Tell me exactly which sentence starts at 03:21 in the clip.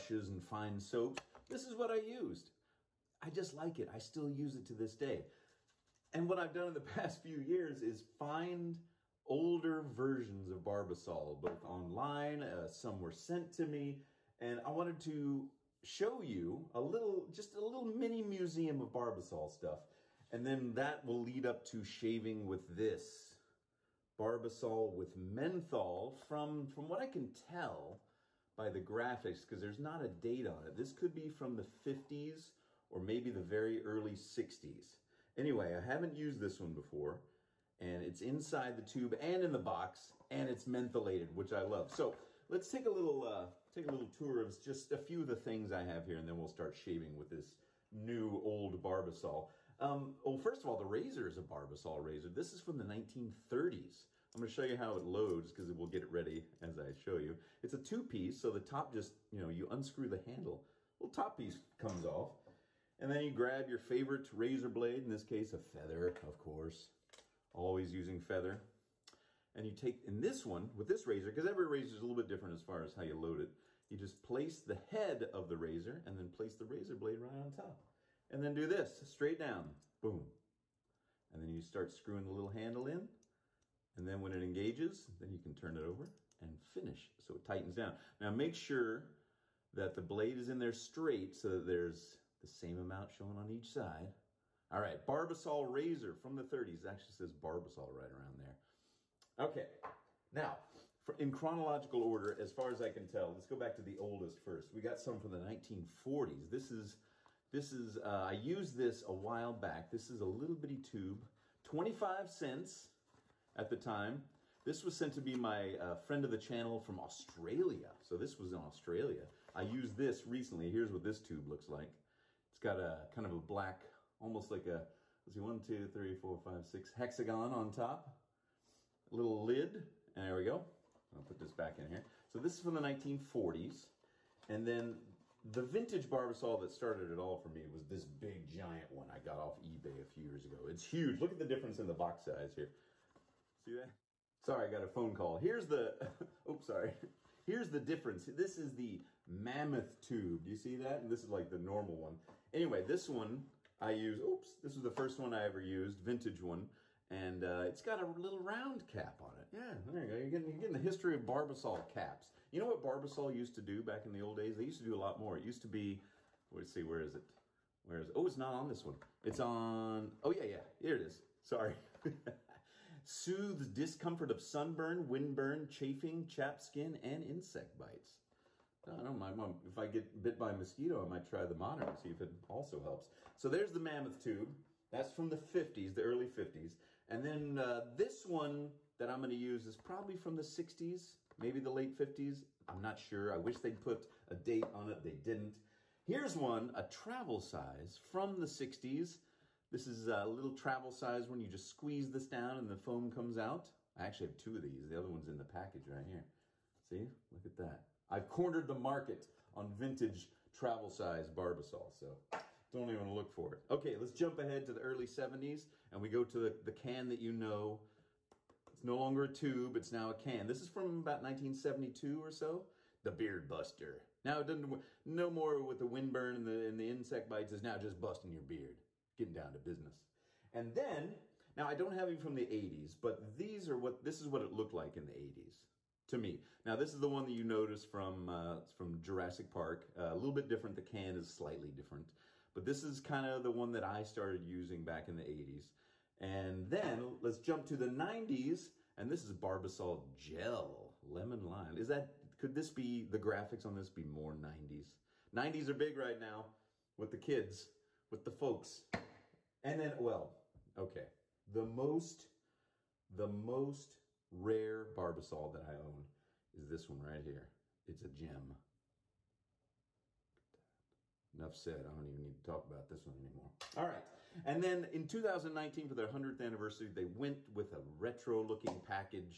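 You just squeeze this down and the foam comes out.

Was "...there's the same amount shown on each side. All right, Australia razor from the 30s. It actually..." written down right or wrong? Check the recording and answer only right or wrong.
wrong.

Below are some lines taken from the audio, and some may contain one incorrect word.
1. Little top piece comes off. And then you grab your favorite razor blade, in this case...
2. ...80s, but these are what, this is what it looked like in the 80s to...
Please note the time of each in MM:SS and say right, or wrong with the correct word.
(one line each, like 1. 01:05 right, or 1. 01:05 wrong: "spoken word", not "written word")
1. 01:00 right
2. 03:52 right.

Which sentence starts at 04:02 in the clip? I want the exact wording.
But this is kind of the one that I started using back in the 80s.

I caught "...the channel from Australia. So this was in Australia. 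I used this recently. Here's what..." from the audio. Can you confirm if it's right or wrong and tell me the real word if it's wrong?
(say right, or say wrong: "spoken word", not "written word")
right.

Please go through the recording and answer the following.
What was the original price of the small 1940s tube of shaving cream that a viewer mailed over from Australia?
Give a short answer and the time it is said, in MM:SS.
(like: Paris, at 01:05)
25 cents, at 01:51.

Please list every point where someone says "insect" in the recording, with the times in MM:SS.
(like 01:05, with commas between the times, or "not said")
02:57, 03:46.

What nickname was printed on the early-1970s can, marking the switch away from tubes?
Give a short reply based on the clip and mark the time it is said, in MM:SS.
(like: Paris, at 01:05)
The Beard Buster, at 03:43.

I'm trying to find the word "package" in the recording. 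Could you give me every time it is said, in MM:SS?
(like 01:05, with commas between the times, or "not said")
03:25, 04:38.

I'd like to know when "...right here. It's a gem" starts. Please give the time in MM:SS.
04:27.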